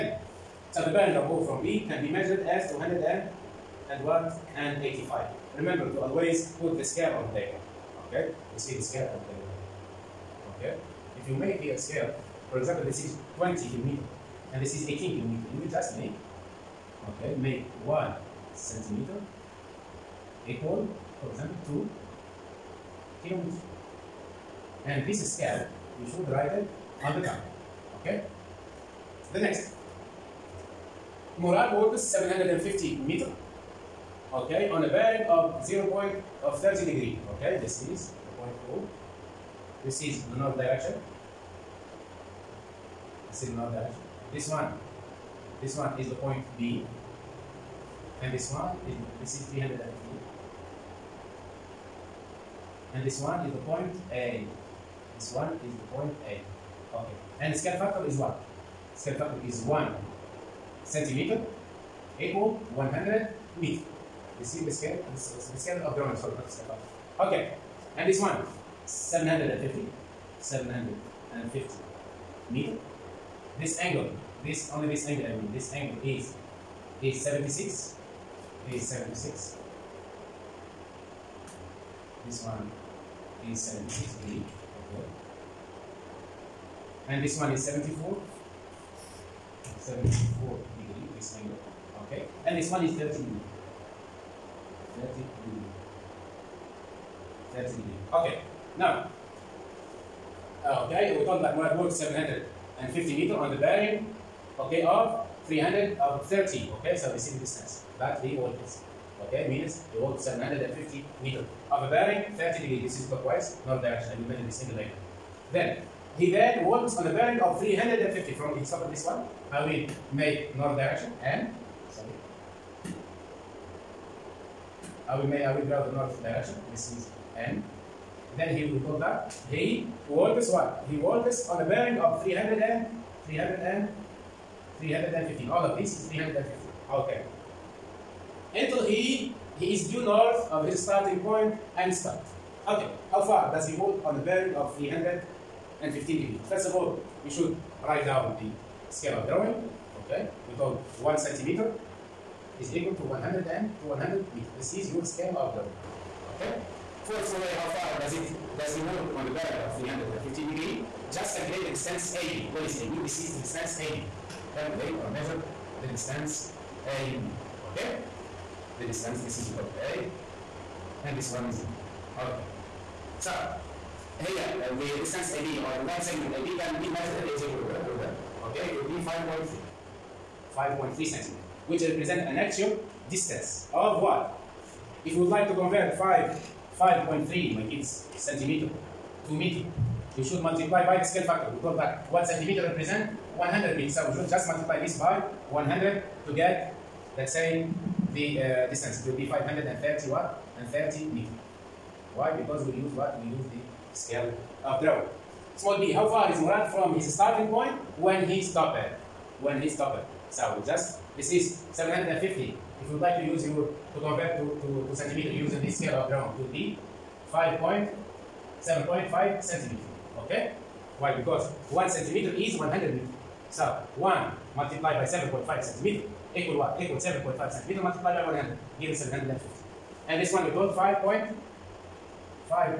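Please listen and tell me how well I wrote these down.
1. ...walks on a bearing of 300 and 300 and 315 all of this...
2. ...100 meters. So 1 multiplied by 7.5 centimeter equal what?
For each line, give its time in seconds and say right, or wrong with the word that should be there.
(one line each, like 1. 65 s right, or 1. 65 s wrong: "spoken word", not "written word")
1. 130 s right
2. 222 s right.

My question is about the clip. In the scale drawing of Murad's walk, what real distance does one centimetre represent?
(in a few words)
100 meters.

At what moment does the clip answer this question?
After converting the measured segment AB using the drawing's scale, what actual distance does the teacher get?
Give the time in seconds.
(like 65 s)
199 s.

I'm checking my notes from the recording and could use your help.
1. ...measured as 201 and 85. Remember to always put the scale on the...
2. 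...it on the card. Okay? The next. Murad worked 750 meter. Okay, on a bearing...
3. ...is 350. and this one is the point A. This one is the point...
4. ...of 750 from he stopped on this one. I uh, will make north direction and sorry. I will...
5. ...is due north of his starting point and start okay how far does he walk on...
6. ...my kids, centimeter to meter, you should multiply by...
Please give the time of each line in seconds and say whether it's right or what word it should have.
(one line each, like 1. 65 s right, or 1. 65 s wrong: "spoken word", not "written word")
1. 2 s right
2. 26 s right
3. 49 s right
4. 117 s wrong: "350", not "750"
5. 139 s right
6. 187 s right.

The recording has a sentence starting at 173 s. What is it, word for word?
So هي the distance AB or the line segment AB can be measured using ruler.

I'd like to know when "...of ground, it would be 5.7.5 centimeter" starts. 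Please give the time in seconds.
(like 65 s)
215 s.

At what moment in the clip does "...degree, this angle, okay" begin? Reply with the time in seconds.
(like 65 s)
90 s.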